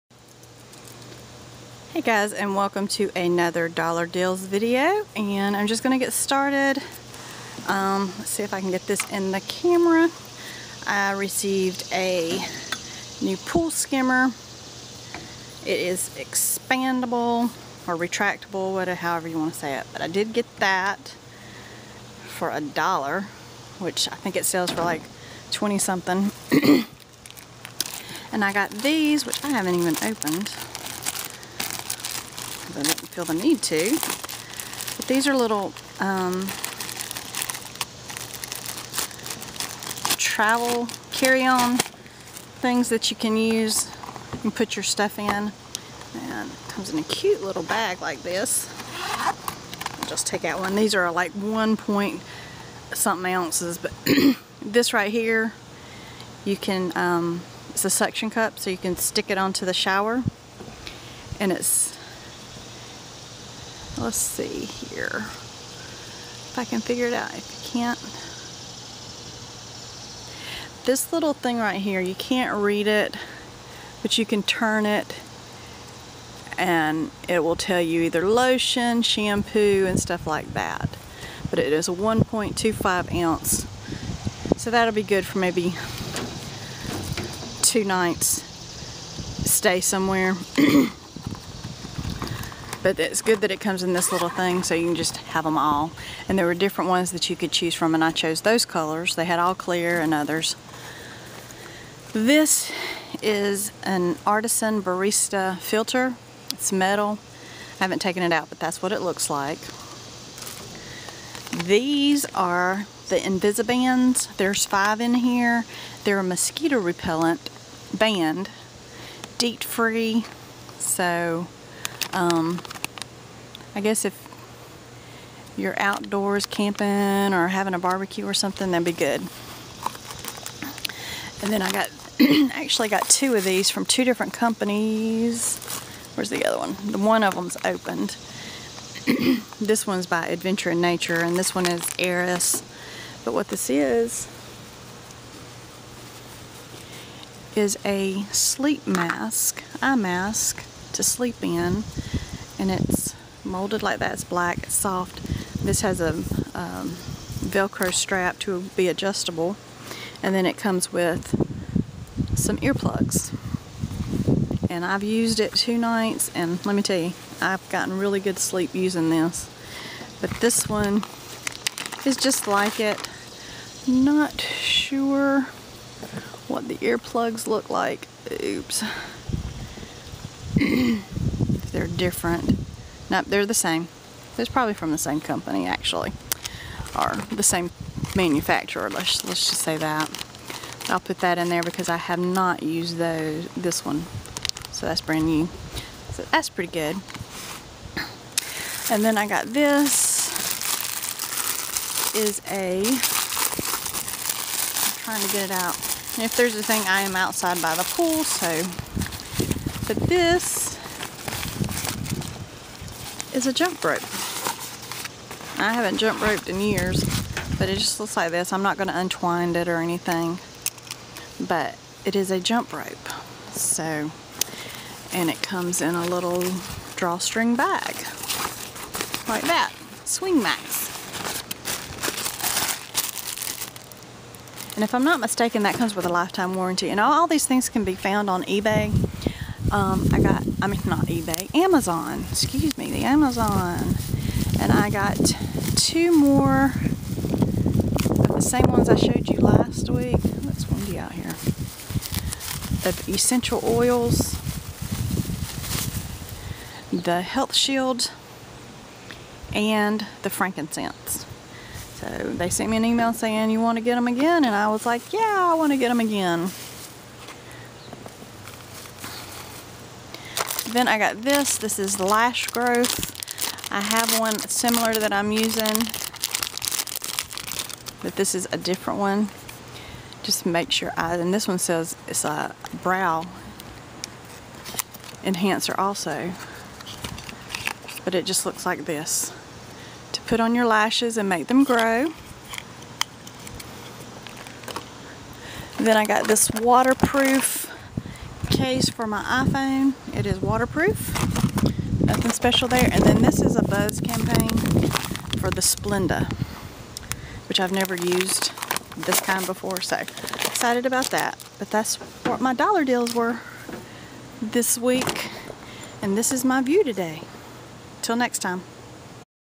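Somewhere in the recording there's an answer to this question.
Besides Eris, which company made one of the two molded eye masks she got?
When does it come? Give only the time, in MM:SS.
02:20.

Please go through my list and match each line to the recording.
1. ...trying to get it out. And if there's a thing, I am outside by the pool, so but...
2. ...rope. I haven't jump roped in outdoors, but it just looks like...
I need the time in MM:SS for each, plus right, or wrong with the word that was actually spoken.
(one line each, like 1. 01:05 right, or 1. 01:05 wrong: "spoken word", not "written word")
1. 03:24 right
2. 03:33 wrong: "years", not "outdoors".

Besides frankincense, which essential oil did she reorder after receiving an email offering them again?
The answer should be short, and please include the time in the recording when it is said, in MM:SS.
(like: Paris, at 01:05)
Health Shield, at 04:16.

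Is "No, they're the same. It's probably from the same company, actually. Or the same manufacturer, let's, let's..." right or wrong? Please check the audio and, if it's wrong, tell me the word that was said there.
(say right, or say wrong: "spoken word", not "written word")
right.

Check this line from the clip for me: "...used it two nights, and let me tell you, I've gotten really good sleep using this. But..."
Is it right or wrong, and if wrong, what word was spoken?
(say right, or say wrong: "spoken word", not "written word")
right.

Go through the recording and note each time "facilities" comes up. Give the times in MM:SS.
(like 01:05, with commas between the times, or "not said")
not said.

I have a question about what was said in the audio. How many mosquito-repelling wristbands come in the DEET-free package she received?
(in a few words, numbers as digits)
5.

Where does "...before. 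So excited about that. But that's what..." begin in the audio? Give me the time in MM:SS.
05:09.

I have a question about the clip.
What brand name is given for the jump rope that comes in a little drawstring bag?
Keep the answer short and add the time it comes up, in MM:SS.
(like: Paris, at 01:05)
Swing Max, at 03:50.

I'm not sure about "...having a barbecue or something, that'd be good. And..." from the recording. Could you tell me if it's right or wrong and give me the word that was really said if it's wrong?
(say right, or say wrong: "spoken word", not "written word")
right.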